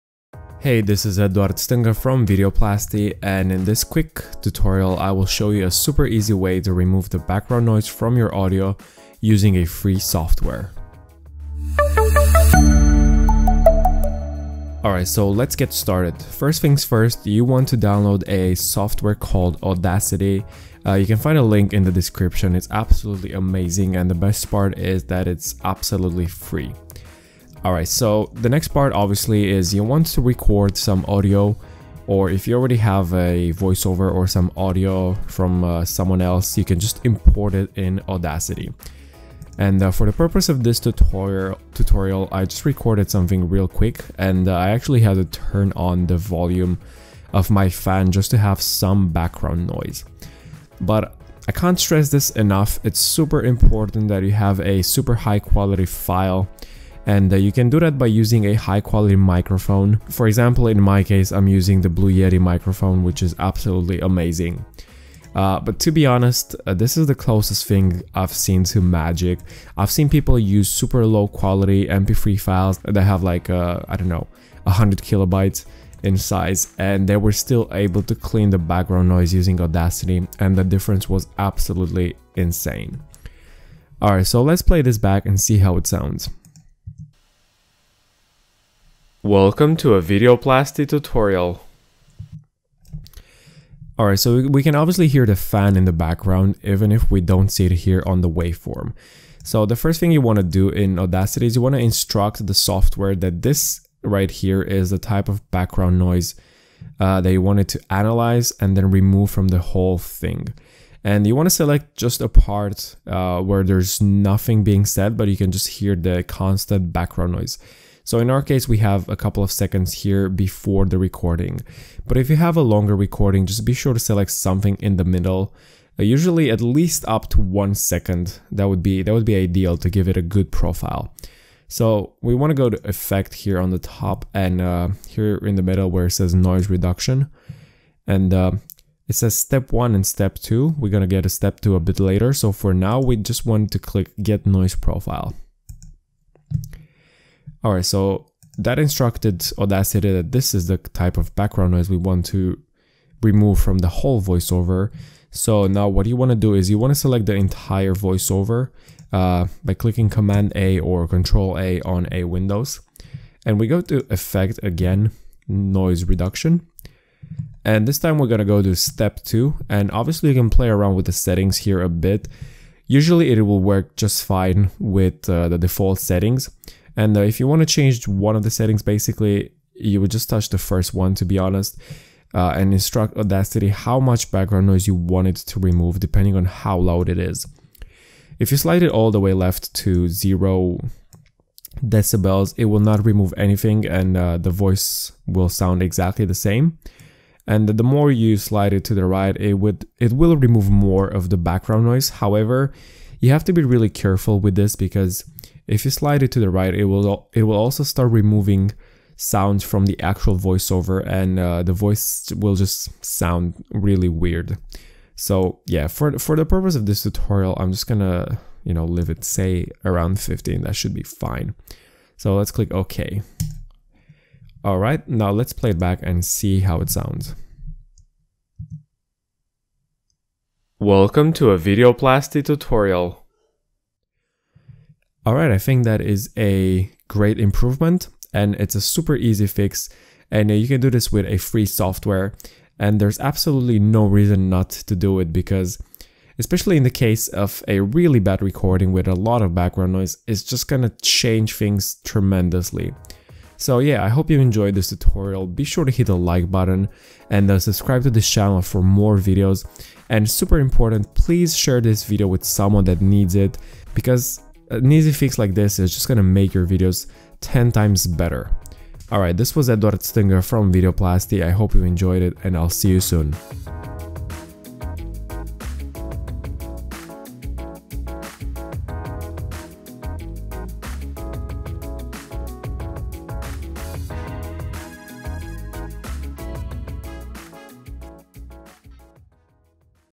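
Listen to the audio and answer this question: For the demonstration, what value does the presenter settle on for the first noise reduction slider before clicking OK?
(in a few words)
15.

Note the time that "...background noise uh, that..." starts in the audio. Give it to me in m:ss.
1:45.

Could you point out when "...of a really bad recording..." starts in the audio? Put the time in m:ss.
4:07.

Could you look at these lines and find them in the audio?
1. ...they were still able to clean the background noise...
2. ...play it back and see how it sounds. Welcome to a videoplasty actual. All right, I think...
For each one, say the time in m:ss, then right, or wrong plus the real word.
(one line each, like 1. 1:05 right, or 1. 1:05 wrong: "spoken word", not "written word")
1. 1:17 right
2. 3:45 wrong: "tutorial", not "actual".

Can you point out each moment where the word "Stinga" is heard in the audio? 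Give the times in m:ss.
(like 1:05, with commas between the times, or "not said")
0:01, 4:29.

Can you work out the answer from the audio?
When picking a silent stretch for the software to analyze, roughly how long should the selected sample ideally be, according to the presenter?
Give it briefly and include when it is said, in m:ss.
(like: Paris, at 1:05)
1 second, at 2:07.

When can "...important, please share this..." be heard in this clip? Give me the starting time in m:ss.
4:20.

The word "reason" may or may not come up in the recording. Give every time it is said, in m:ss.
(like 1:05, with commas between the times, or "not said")
4:04.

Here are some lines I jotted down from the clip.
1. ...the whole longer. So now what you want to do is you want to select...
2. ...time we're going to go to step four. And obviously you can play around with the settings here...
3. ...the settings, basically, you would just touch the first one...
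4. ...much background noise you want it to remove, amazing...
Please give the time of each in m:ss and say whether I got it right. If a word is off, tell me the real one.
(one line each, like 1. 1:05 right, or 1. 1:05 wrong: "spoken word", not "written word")
1. 2:33 wrong: "voiceover", not "longer"
2. 2:47 wrong: "two", not "four"
3. 2:58 right
4. 3:03 wrong: "depending", not "amazing".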